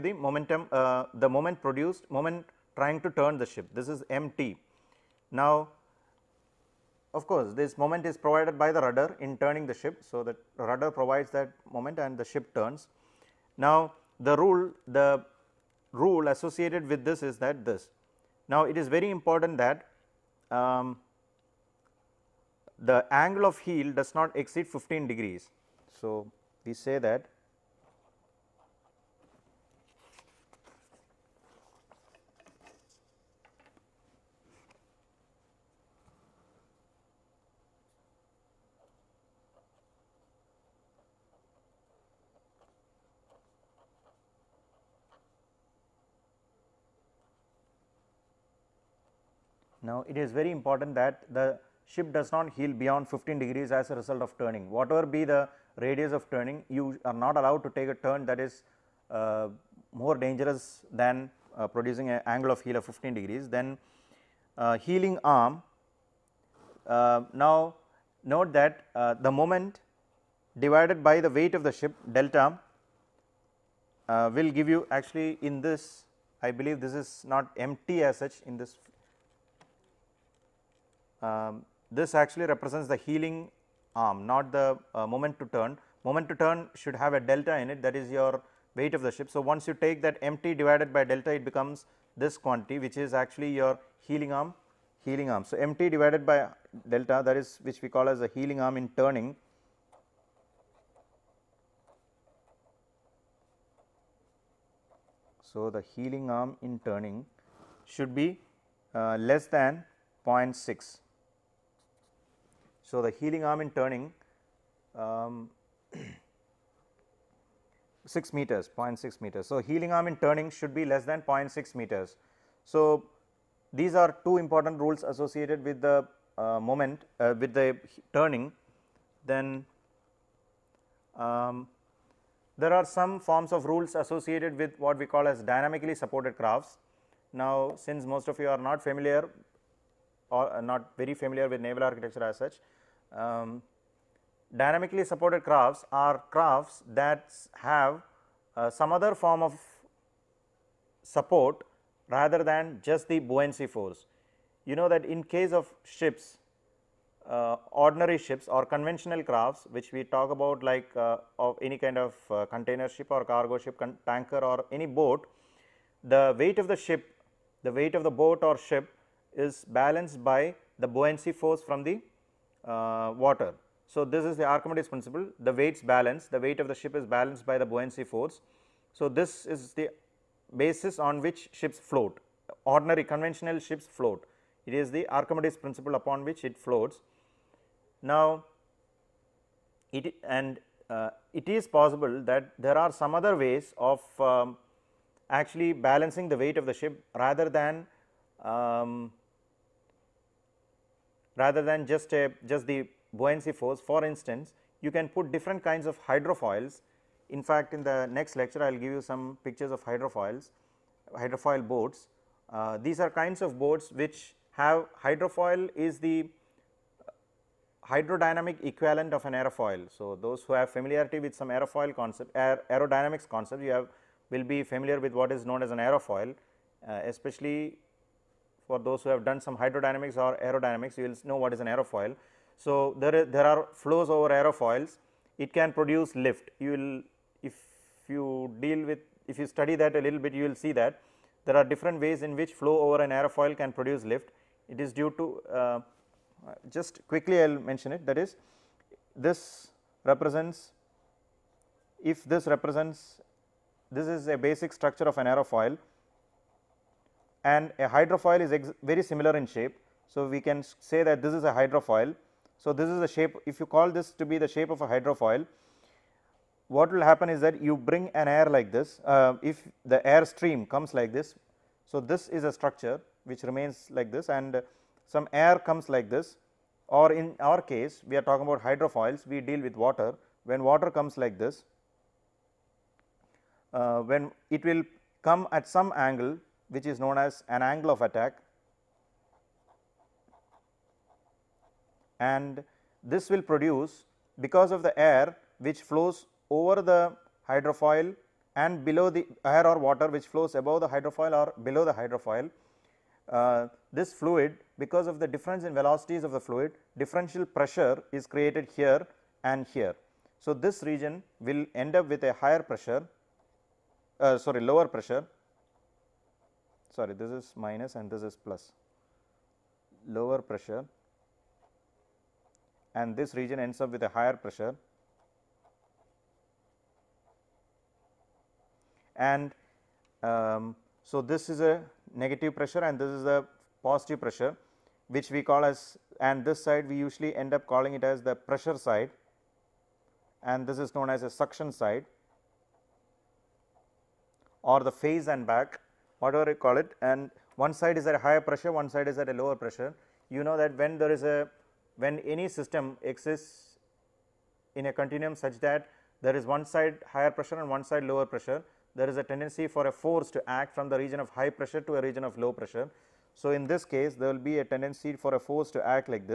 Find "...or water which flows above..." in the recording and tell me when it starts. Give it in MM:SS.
04:59.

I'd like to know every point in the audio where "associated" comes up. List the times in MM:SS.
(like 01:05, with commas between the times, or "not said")
00:16, 02:05, 02:13.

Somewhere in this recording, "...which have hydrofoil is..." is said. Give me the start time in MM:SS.
03:33.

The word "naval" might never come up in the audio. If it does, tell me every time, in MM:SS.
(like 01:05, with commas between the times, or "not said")
02:21.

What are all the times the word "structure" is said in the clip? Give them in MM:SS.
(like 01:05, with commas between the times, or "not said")
04:14, 04:32.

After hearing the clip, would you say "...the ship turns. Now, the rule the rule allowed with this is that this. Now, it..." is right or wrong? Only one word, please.
wrong.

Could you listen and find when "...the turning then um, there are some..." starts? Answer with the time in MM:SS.
02:07.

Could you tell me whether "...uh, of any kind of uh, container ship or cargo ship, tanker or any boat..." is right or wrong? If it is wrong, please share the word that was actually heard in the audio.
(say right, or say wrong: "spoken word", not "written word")
right.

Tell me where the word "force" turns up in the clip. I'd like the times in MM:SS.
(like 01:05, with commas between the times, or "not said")
02:33, 02:51, 02:58, 03:23, 05:59, 06:05.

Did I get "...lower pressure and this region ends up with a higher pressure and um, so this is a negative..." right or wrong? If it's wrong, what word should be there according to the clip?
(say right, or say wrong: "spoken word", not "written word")
right.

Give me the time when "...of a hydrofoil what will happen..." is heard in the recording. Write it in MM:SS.
04:24.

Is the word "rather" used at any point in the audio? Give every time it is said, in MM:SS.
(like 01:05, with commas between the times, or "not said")
02:32, 03:17, 03:21.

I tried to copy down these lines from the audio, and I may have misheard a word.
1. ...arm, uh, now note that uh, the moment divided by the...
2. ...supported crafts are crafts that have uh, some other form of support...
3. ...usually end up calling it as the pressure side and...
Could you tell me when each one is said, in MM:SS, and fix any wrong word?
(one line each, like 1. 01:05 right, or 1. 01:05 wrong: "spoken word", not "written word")
1. 01:05 right
2. 02:25 right
3. 05:36 right.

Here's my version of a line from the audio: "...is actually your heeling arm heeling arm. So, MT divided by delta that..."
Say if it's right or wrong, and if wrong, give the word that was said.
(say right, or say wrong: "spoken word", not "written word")
right.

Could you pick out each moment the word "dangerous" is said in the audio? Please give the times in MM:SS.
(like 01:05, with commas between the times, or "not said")
01:00.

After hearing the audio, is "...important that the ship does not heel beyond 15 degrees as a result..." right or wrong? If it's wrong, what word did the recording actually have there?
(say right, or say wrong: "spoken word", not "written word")
right.